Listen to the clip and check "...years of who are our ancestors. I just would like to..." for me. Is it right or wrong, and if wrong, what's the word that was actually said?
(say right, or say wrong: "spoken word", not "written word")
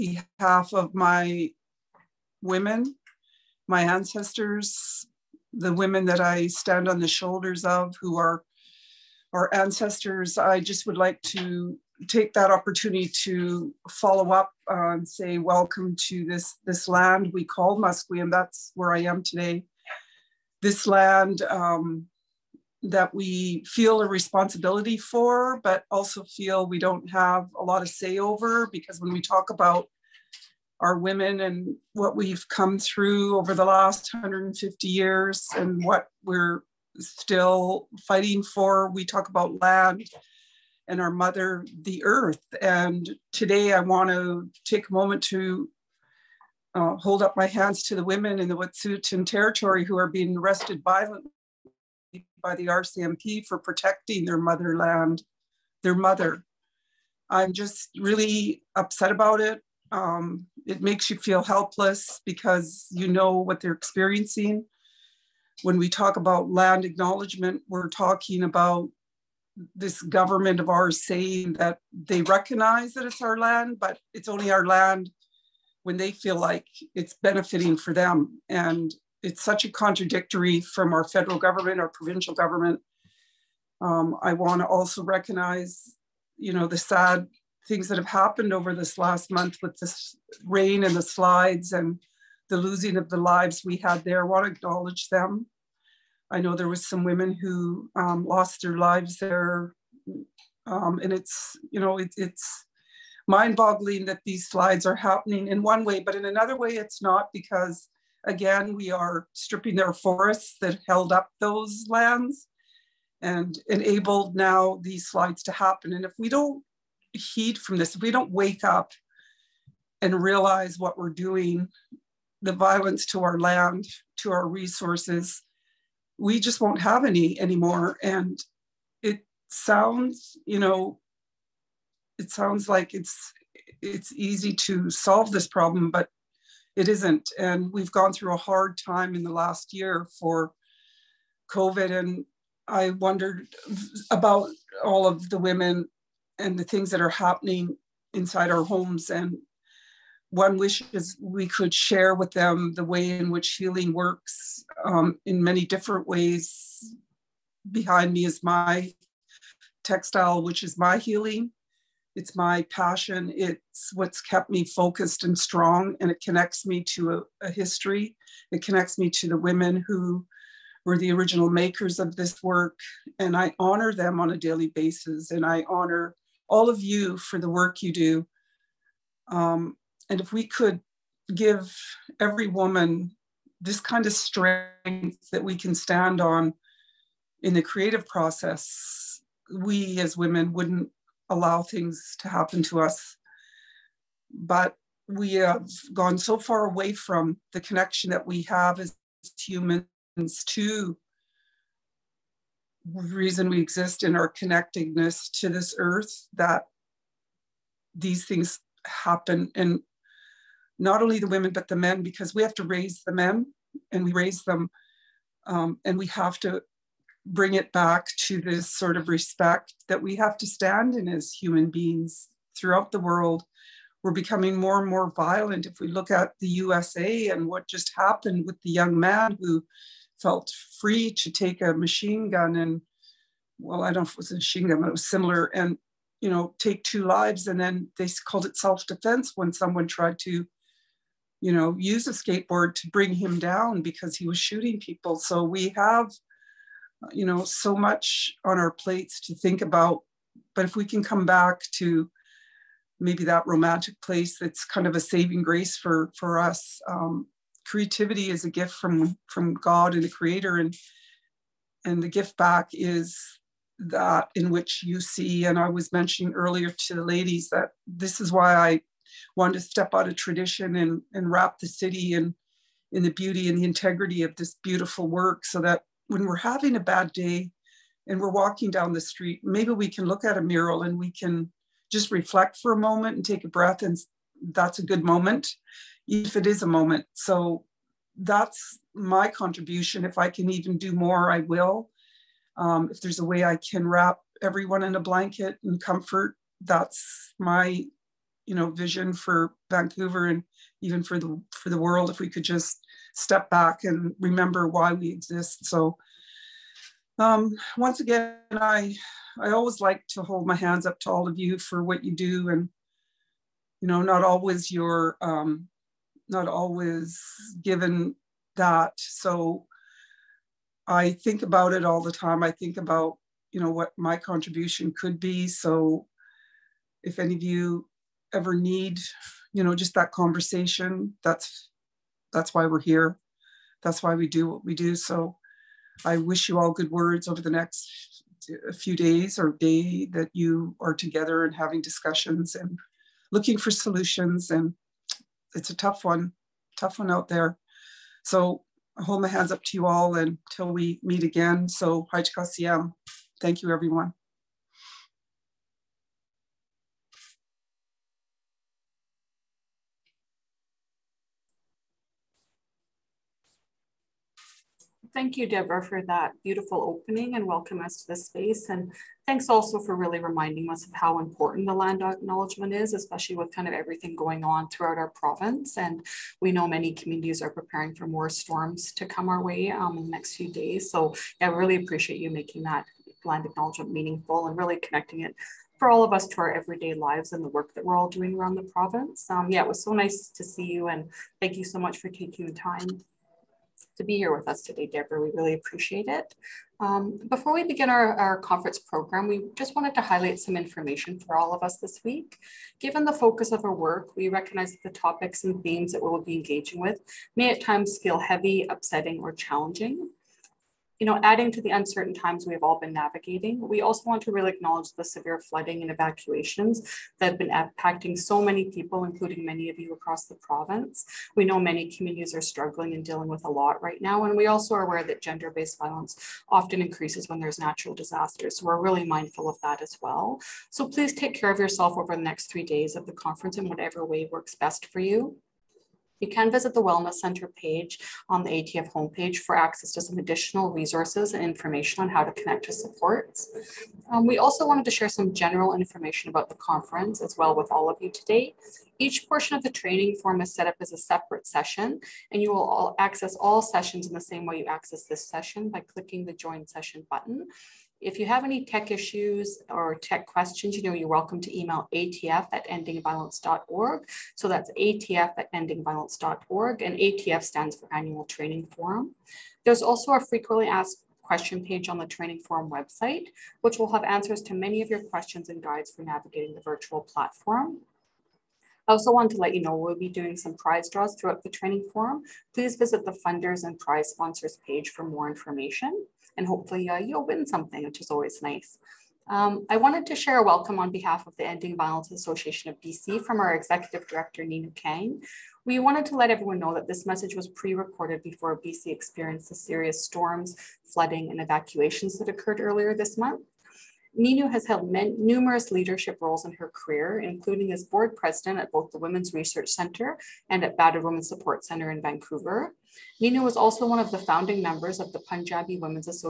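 wrong: "shoulders", not "years".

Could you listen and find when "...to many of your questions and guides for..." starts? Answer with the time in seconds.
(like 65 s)
474 s.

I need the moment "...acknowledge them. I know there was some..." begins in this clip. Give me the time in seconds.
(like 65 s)
94 s.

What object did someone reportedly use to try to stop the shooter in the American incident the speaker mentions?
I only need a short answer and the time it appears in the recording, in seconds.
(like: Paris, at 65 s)
Skateboard, at 242 s.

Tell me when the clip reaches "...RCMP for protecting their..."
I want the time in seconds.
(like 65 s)
52 s.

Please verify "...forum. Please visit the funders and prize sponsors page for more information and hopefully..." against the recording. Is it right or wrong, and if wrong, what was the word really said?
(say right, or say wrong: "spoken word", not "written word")
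right.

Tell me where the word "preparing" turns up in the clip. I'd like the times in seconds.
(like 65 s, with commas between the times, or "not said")
377 s.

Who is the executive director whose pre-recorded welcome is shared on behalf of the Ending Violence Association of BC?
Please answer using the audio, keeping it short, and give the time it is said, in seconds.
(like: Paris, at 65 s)
Ninu Kang, at 494 s.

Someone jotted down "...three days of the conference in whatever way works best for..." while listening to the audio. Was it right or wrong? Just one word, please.
right.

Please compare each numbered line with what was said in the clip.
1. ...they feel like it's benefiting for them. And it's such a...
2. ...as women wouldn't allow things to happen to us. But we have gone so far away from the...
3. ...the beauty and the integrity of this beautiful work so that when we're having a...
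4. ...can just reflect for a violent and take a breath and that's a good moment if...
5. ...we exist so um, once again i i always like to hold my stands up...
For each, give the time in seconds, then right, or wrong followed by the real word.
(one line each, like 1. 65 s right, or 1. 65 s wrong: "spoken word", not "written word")
1. 75 s right
2. 189 s right
3. 273 s right
4. 281 s wrong: "moment", not "violent"
5. 304 s wrong: "hands", not "stands".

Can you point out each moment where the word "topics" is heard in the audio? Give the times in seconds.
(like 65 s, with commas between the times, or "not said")
404 s.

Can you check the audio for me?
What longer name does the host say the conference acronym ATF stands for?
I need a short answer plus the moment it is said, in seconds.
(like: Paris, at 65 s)
Annual Training Forum, at 467 s.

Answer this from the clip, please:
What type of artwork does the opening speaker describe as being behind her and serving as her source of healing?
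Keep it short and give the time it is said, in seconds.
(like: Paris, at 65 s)
Textile, at 159 s.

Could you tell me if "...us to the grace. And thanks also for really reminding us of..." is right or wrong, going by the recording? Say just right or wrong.
wrong.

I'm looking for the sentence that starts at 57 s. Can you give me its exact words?
I'm just really upset about it.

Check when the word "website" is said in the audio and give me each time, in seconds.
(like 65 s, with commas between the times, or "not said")
472 s.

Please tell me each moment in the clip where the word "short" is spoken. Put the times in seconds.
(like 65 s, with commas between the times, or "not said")
not said.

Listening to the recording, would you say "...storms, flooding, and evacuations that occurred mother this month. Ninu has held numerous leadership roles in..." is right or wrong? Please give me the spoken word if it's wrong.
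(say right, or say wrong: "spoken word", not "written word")
wrong: "earlier", not "mother".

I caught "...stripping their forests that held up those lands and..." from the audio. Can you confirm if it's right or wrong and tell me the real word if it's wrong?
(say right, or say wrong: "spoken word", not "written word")
right.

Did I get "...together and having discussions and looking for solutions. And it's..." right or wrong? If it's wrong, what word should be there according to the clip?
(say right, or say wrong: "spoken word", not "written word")
right.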